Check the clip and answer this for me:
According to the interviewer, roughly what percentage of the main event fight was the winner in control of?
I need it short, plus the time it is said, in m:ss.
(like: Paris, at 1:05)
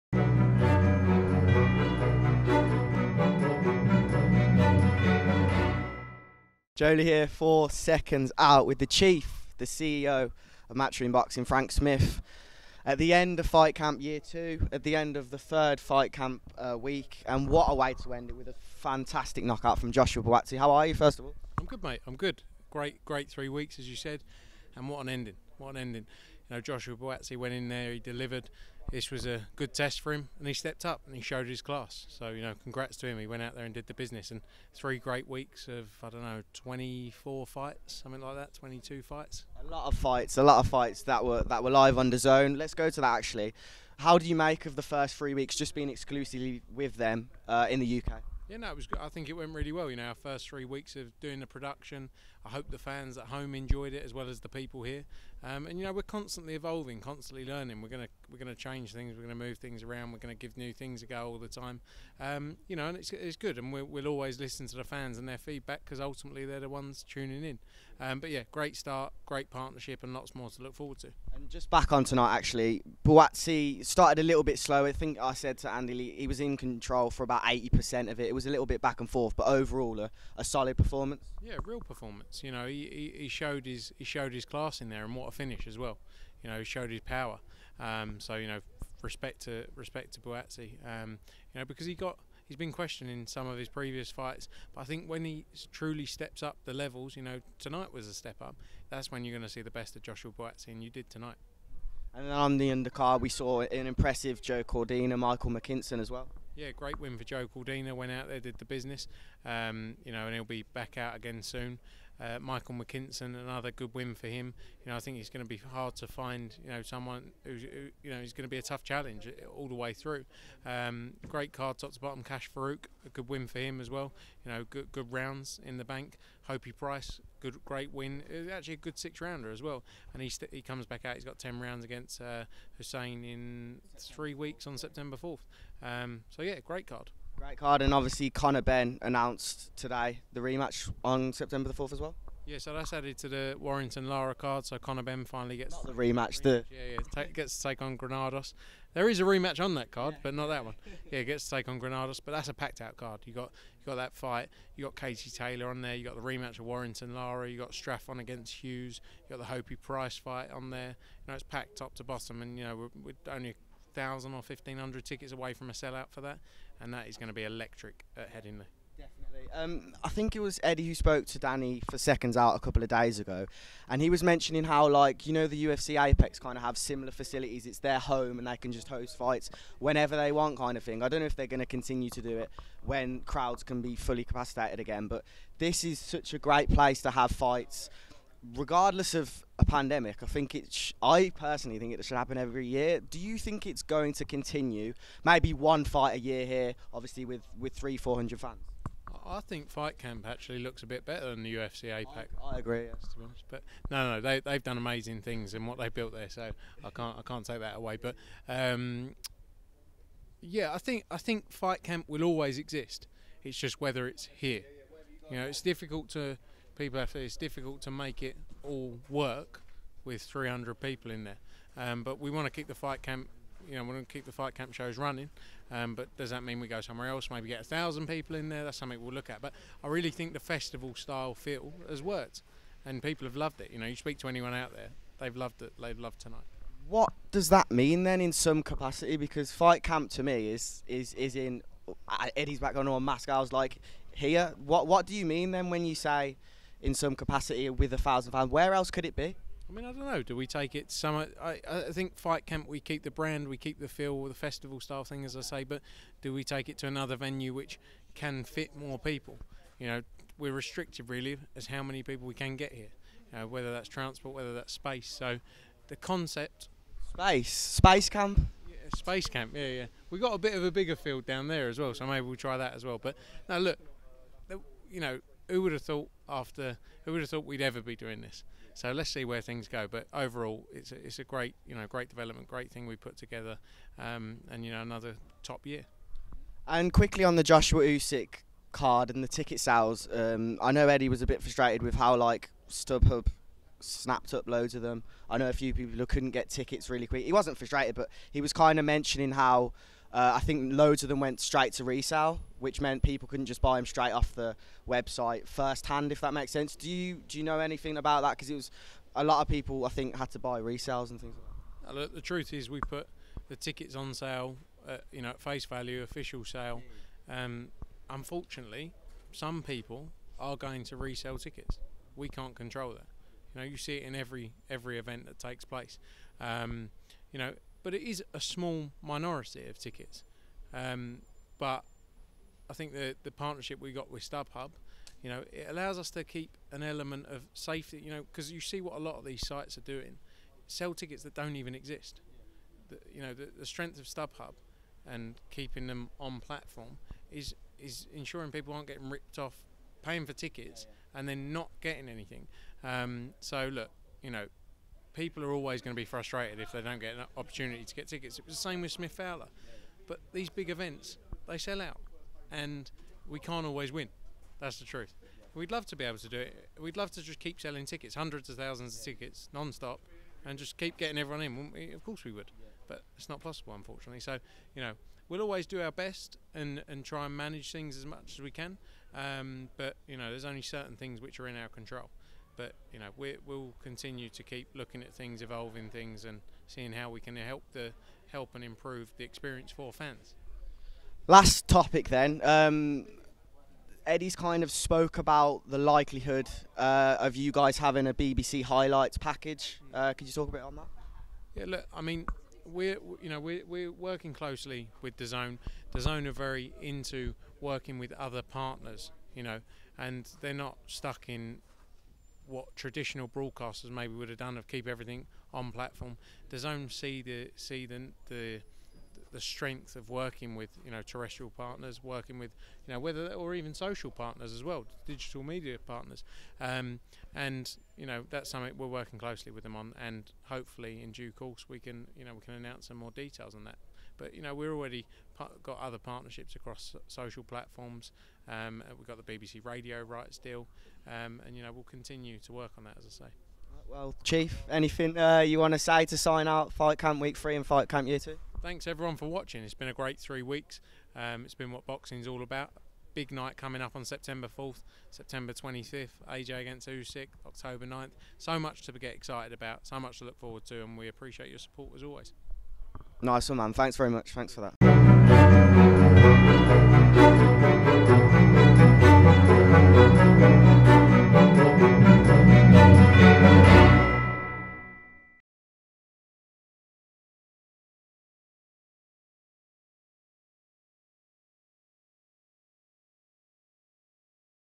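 80%, at 1:17.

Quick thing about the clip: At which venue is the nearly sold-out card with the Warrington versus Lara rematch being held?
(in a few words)
Headingley.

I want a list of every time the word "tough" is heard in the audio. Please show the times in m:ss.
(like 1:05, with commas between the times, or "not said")
1:58.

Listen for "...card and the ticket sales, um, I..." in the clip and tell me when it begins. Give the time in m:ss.
4:48.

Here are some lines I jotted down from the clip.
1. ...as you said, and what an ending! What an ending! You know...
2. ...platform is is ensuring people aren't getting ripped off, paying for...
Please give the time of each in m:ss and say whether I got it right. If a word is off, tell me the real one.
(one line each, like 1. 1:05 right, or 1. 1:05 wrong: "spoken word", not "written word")
1. 0:23 right
2. 5:46 right.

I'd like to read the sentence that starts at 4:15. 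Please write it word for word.
But do we take it to another venue which can fit more people?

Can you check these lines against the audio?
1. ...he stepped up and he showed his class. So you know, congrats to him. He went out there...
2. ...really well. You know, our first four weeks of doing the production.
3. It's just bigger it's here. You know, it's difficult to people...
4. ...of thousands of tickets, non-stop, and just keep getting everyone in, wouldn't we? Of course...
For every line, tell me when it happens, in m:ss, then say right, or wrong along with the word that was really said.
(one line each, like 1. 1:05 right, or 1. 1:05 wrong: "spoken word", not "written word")
1. 0:30 right
2. 0:49 wrong: "three", not "four"
3. 3:33 wrong: "whether", not "bigger"
4. 6:08 right.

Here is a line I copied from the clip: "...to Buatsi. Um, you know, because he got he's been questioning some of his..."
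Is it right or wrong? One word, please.
right.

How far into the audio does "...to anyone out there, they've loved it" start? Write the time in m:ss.
3:54.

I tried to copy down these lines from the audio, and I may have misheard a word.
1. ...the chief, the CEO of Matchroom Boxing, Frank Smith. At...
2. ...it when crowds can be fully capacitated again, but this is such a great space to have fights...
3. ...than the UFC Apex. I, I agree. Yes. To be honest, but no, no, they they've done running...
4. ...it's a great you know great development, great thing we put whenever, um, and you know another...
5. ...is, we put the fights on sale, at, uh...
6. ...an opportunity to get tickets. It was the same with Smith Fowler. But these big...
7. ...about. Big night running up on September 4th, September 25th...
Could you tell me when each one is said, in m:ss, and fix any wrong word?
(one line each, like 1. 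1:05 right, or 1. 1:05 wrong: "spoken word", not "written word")
1. 0:08 right
2. 3:02 wrong: "place", not "space"
3. 3:21 wrong: "amazing", not "running"
4. 4:40 wrong: "together", not "whenever"
5. 5:12 wrong: "tickets", not "fights"
6. 5:57 right
7. 7:32 wrong: "coming", not "running".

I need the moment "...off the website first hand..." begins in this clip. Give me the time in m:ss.
5:04.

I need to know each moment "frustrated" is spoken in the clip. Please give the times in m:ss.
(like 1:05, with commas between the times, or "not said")
4:51, 4:57, 5:56.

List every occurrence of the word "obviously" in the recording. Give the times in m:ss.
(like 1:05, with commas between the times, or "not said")
2:17, 3:16.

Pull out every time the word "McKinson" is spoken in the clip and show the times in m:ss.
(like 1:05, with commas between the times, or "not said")
1:45, 1:52.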